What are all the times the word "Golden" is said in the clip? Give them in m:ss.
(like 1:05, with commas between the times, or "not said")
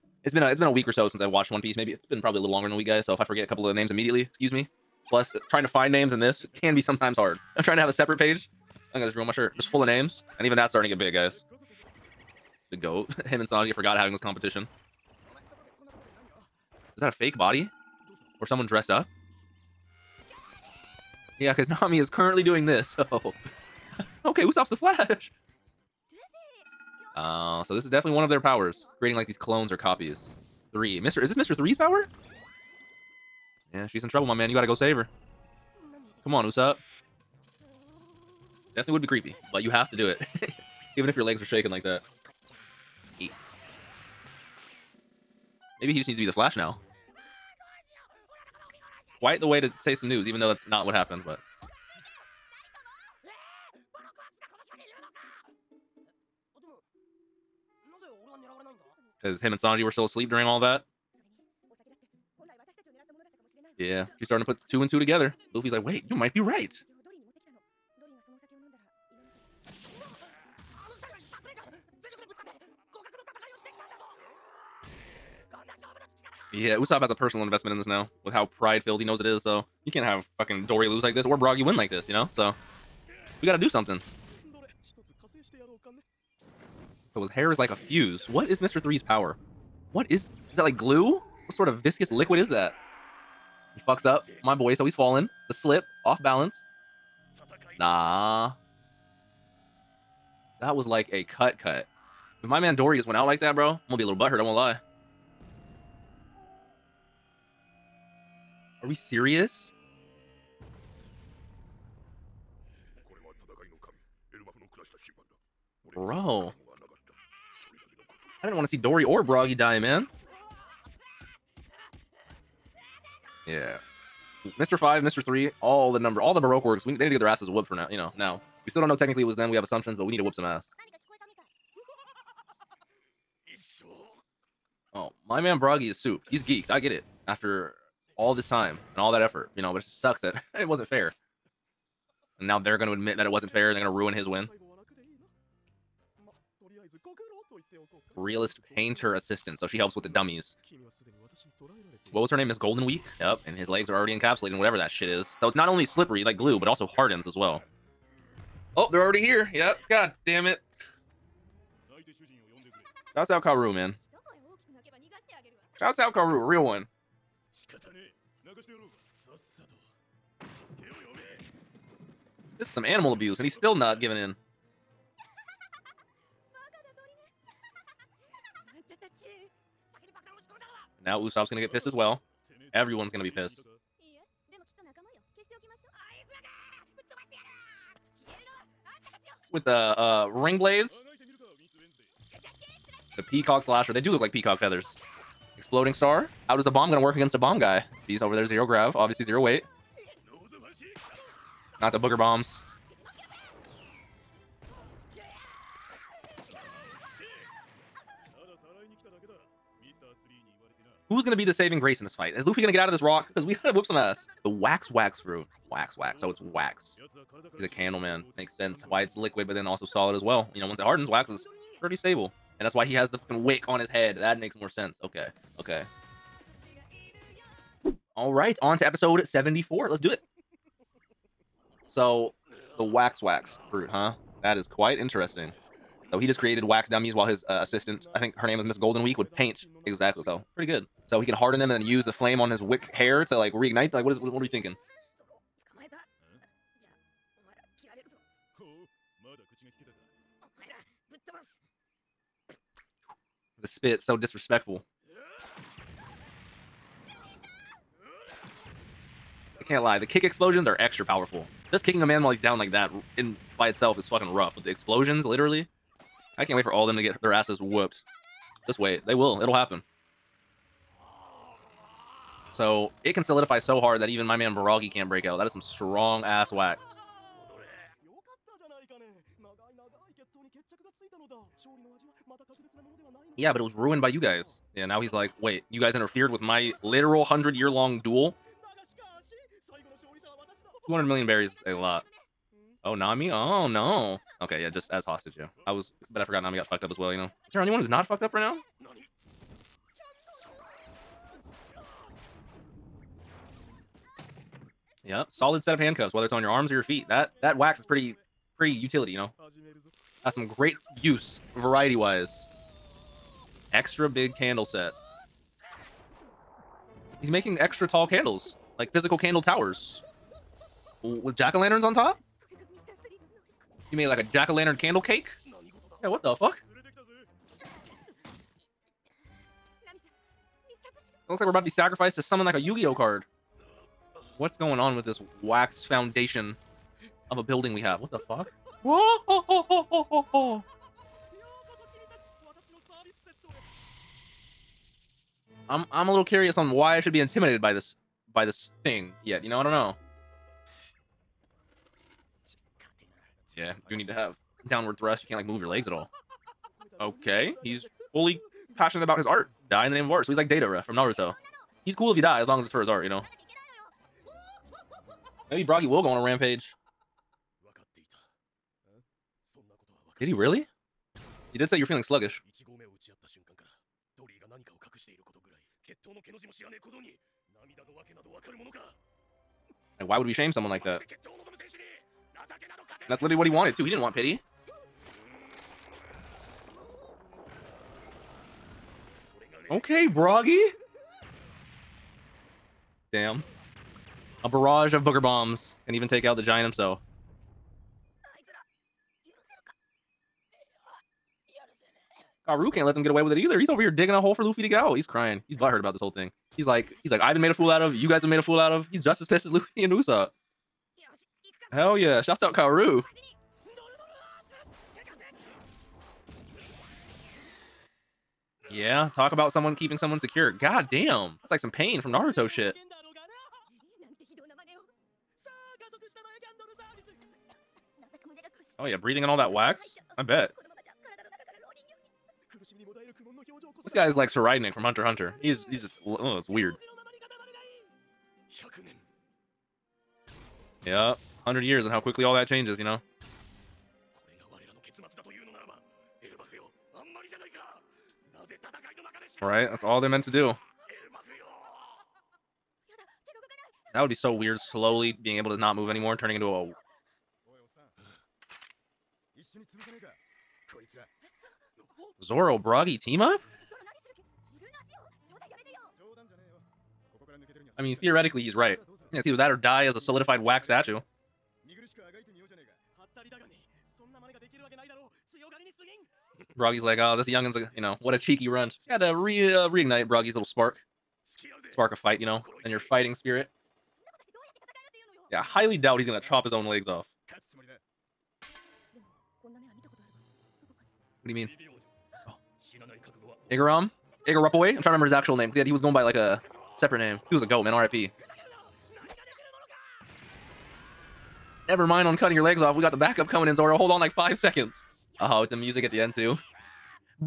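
2:32, 3:58.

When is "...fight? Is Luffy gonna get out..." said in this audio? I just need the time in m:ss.
3:32.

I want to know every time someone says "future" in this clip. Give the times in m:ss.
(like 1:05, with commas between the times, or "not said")
not said.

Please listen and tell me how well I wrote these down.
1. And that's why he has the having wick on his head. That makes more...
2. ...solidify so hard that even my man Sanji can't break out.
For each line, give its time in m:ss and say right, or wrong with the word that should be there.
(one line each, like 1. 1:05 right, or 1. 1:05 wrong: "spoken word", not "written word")
1. 3:42 wrong: "fucking", not "having"
2. 4:33 wrong: "Baragi", not "Sanji".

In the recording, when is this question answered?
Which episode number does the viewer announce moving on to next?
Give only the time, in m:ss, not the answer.
3:48.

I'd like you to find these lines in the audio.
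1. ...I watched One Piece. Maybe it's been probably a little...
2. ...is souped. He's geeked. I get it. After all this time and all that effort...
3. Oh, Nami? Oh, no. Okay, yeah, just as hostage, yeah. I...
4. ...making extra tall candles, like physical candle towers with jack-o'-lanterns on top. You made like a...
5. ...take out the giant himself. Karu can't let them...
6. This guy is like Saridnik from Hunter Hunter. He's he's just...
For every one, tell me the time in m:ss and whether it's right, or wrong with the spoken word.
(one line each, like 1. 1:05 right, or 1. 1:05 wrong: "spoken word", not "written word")
1. 0:01 right
2. 2:15 right
3. 4:52 right
4. 5:17 right
5. 6:36 right
6. 7:13 right.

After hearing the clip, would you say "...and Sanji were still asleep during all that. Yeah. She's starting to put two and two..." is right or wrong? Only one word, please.
right.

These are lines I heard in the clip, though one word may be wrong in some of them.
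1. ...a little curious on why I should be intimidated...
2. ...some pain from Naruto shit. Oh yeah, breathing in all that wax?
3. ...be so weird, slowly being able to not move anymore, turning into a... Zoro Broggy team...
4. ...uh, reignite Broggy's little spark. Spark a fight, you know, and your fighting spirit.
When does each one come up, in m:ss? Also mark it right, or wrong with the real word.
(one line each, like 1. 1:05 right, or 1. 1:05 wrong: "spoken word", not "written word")
1. 5:46 right
2. 7:01 right
3. 7:34 right
4. 7:59 right.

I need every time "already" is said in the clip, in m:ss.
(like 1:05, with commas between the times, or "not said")
2:33, 2:39.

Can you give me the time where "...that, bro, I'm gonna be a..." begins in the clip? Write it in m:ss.
1:43.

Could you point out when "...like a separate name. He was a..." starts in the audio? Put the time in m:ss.
8:16.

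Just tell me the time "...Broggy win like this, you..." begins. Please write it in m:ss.
1:21.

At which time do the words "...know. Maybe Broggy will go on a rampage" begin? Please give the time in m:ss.
6:03.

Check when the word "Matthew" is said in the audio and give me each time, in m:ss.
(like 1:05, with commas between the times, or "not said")
not said.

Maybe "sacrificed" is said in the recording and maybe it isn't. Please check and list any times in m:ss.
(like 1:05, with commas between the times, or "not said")
5:31.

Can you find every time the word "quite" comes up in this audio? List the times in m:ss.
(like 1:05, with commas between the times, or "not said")
0:49, 3:54.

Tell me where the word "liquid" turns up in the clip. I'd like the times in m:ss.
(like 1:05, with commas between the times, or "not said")
1:32, 3:39.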